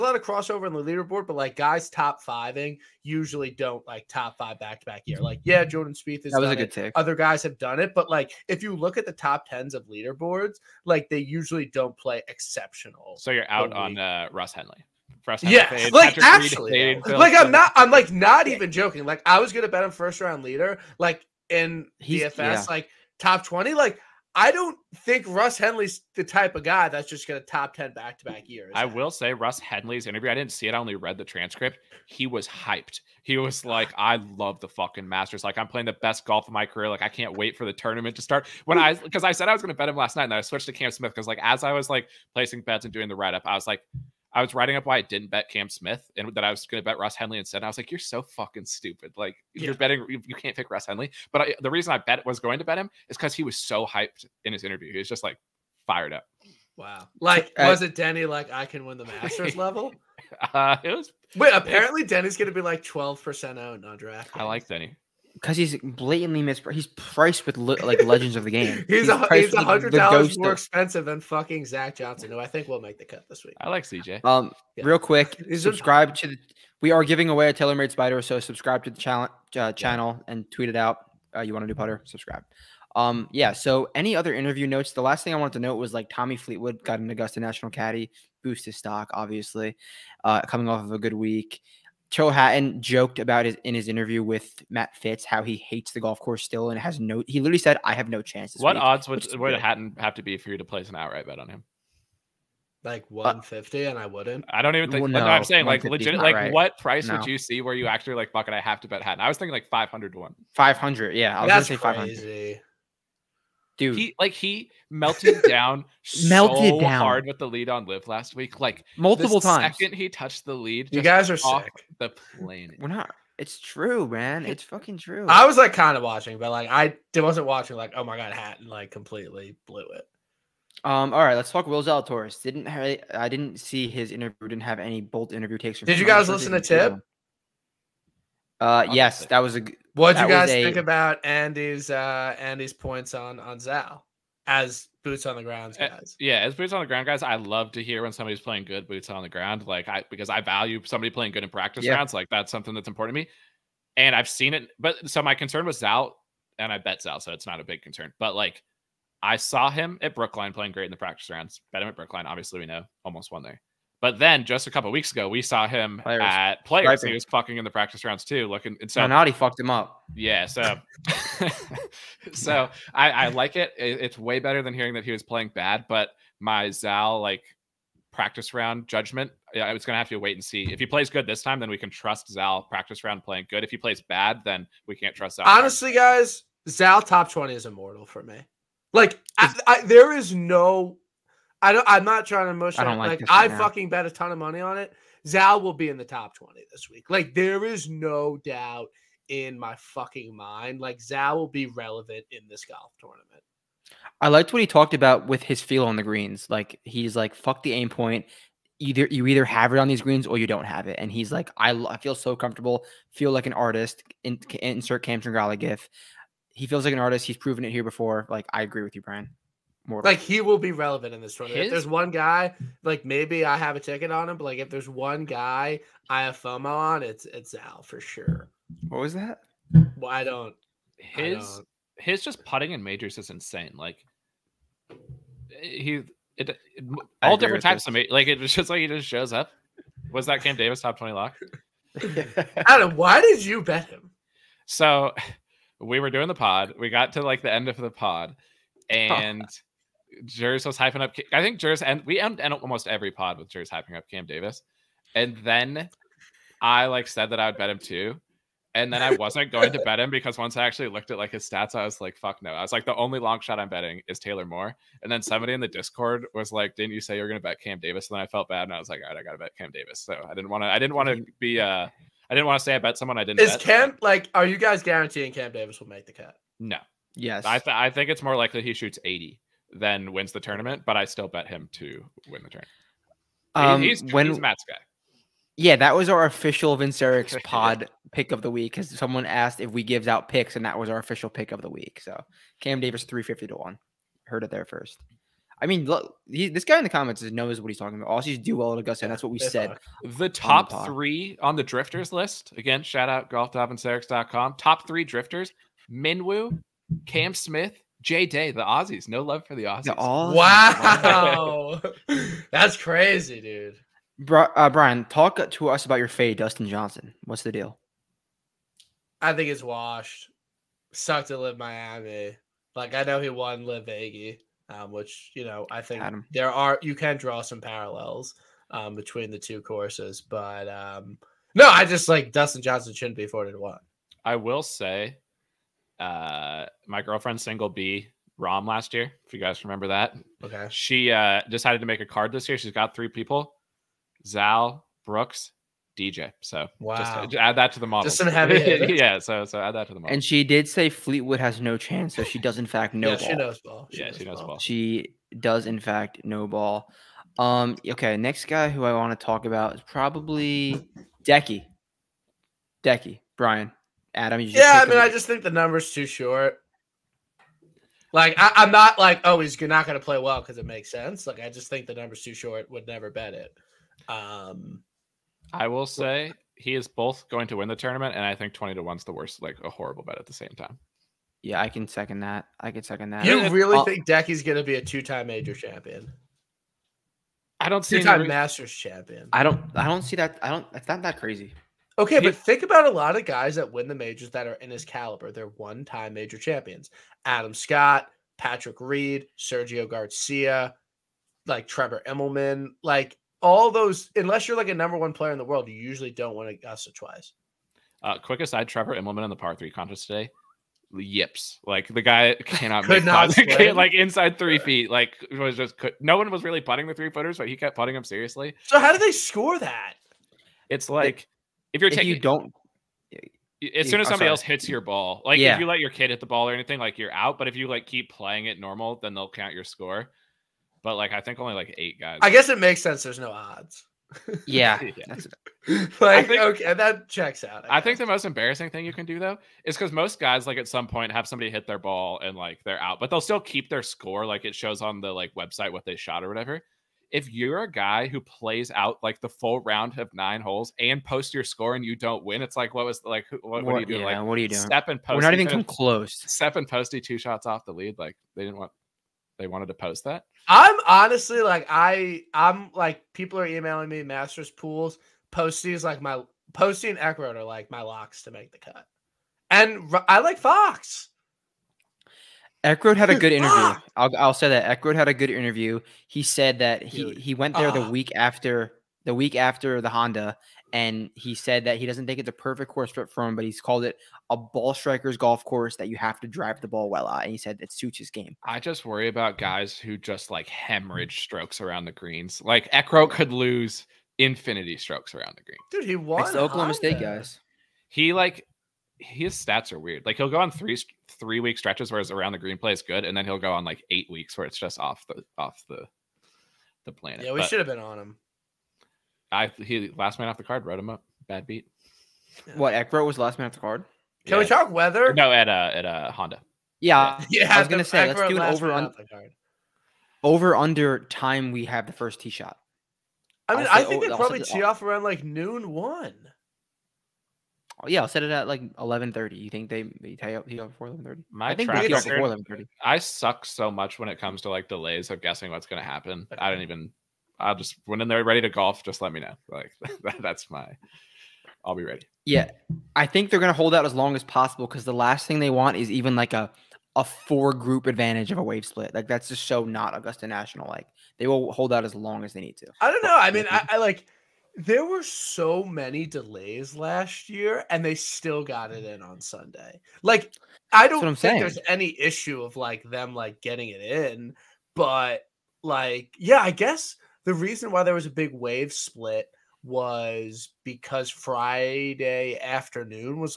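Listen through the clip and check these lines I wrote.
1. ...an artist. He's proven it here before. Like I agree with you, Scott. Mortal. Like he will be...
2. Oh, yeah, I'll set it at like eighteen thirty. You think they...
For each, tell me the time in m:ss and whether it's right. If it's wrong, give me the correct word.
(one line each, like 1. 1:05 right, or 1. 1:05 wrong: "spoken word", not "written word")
1. 3:36 wrong: "Brian", not "Scott"
2. 8:47 wrong: "eleven", not "eighteen".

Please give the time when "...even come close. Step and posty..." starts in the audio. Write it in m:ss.
7:35.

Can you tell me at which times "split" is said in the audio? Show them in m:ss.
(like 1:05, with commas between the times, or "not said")
9:08, 9:28.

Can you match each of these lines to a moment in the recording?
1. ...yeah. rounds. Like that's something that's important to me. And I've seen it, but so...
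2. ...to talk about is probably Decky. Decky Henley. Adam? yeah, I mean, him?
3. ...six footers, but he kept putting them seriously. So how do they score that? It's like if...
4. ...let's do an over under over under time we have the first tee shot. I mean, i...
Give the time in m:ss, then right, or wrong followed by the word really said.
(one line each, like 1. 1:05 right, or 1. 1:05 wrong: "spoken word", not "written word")
1. 2:31 right
2. 5:59 wrong: "Brian", not "Henley"
3. 6:56 wrong: "three", not "six"
4. 8:38 right.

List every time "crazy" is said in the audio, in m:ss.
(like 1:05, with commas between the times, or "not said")
5:12, 6:31.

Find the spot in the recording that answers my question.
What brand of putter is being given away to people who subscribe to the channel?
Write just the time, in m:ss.
1:17.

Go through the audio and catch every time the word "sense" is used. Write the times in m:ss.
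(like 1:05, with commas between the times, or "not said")
6:10, 7:12.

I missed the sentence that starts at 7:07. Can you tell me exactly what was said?
But if you like keep playing it normal, then they'll count your score.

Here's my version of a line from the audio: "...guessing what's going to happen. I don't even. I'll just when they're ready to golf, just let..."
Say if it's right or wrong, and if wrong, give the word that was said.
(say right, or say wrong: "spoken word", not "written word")
right.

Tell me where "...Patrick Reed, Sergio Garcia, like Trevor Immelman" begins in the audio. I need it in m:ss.
6:38.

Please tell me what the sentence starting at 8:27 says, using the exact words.
Yeah, we should have been on him.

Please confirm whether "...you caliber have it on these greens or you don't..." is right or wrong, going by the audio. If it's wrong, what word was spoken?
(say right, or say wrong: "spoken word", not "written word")
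wrong: "either", not "caliber".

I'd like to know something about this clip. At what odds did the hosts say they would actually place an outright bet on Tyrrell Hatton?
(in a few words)
500 to 1.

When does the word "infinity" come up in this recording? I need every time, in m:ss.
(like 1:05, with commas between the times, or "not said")
8:14.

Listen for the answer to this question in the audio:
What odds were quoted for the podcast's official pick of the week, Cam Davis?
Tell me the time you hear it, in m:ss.
4:53.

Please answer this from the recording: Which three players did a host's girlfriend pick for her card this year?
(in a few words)
Zal, Brooks, DJ.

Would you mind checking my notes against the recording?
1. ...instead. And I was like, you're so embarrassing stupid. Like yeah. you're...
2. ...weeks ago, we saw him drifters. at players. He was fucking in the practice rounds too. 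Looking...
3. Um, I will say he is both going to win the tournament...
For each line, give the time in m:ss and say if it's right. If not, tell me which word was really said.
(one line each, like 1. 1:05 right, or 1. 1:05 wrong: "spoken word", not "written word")
1. 0:47 wrong: "fucking", not "embarrassing"
2. 2:44 wrong: "players", not "drifters"
3. 6:14 right.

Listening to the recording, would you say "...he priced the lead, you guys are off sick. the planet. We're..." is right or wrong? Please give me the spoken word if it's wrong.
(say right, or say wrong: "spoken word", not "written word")
wrong: "touched", not "priced".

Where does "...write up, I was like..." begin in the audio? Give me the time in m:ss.
0:43.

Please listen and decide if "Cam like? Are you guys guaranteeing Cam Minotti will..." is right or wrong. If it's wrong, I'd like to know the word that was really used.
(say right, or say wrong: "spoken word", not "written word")
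wrong: "Davis", not "Minotti".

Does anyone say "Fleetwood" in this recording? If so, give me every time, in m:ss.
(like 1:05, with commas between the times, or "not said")
1:26, 5:50.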